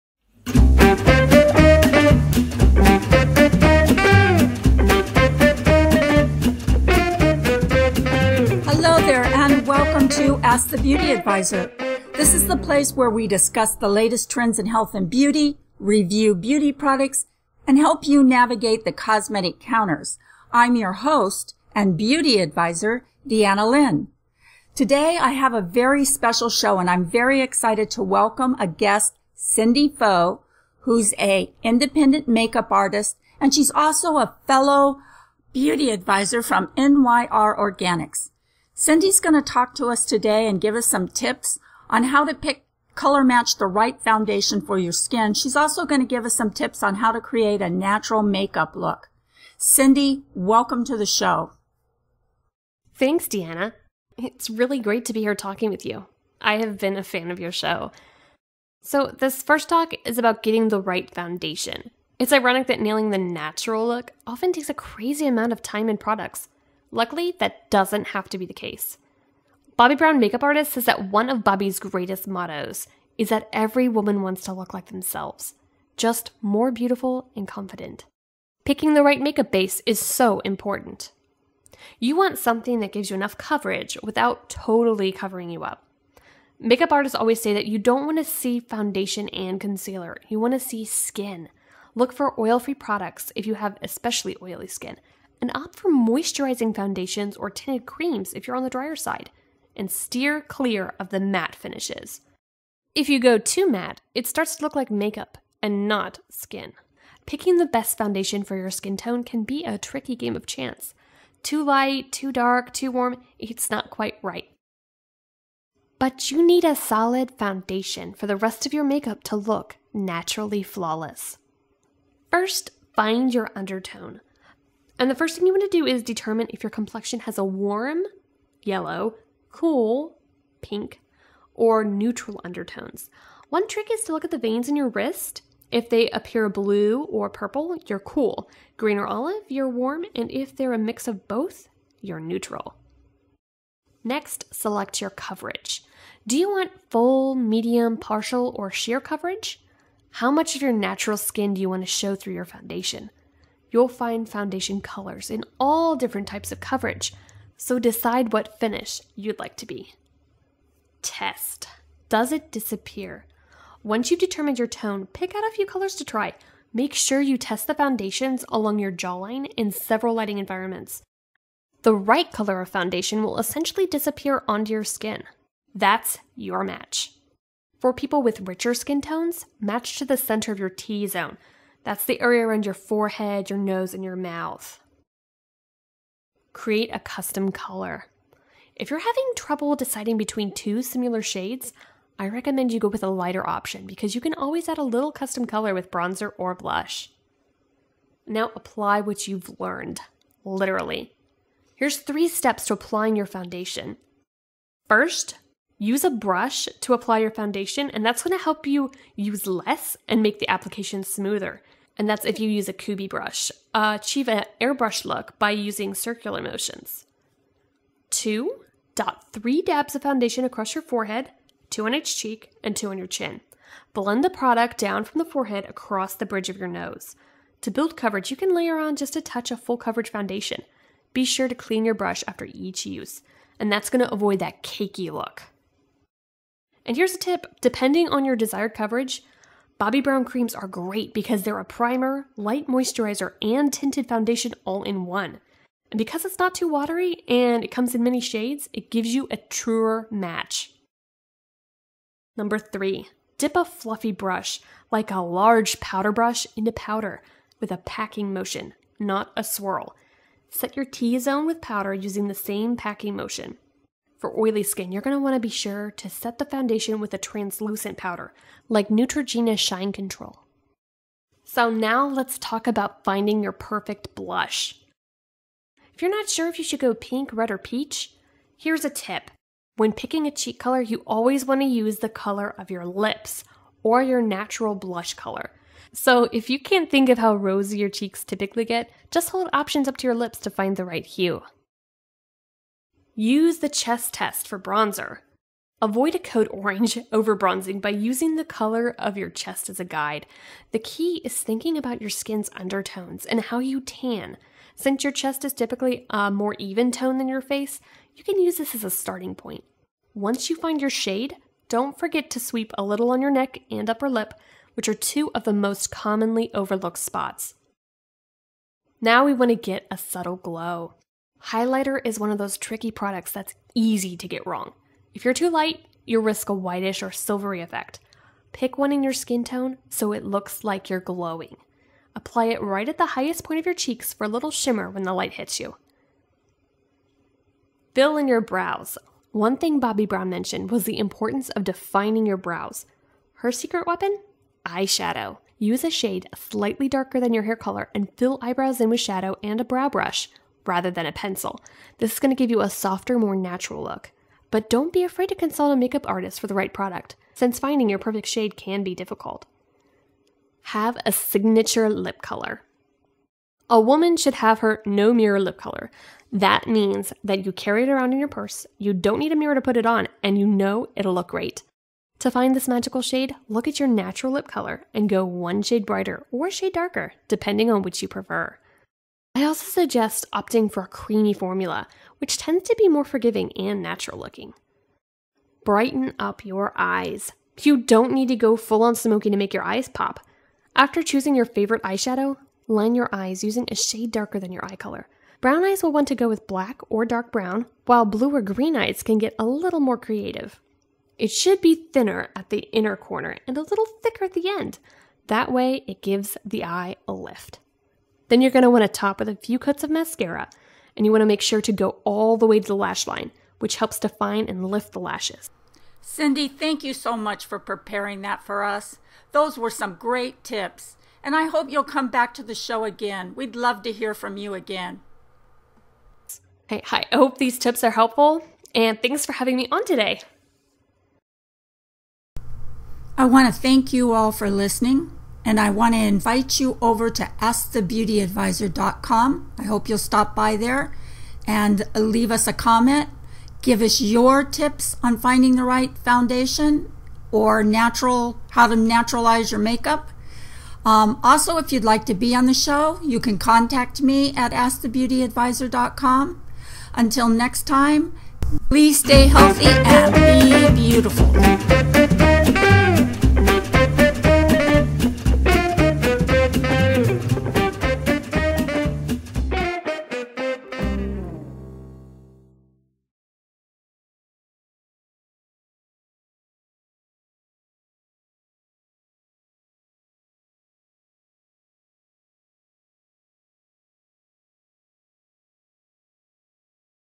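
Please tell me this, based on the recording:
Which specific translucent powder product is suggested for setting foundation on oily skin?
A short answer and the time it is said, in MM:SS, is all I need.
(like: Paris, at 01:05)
Neutrogena Shine Control, at 04:28.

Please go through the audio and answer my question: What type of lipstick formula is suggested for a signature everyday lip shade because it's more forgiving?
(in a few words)
Creamy.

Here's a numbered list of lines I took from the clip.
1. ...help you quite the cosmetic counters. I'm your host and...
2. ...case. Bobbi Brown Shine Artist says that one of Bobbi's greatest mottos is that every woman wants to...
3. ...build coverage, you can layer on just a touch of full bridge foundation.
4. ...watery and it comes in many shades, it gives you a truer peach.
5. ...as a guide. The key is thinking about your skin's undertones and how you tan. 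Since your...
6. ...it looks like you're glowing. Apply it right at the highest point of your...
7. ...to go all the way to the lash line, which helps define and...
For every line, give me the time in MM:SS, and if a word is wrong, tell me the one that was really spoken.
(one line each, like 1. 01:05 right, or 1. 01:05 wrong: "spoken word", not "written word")
1. 00:17 wrong: "navigate", not "quite"
2. 01:08 wrong: "Makeup", not "Shine"
3. 03:47 wrong: "coverage", not "bridge"
4. 04:06 wrong: "match", not "peach"
5. 04:59 right
6. 05:30 right
7. 06:51 right.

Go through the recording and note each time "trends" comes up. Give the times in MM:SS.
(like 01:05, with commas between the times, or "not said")
00:14.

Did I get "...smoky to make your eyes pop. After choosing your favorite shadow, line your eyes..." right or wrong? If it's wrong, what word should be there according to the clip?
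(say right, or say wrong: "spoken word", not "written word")
wrong: "eyeshadow", not "shadow".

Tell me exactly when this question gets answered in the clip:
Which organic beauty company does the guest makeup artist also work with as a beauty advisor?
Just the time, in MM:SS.
00:36.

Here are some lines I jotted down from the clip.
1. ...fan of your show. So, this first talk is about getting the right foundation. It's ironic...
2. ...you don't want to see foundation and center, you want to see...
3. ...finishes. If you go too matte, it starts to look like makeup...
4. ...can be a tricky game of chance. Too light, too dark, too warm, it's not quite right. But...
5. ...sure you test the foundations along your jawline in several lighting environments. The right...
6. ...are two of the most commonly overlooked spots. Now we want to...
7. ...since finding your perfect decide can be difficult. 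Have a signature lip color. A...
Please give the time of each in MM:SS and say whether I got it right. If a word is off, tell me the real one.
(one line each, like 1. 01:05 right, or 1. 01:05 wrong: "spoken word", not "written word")
1. 00:57 right
2. 01:27 wrong: "concealer", not "center"
3. 01:41 right
4. 01:49 right
5. 02:46 right
6. 05:14 right
7. 05:57 wrong: "shade", not "decide".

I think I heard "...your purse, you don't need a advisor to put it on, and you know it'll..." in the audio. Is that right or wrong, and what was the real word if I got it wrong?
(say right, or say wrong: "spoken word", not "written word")
wrong: "mirror", not "advisor".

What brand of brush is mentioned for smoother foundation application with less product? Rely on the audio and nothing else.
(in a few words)
Kubi.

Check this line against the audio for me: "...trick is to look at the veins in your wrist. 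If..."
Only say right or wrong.
right.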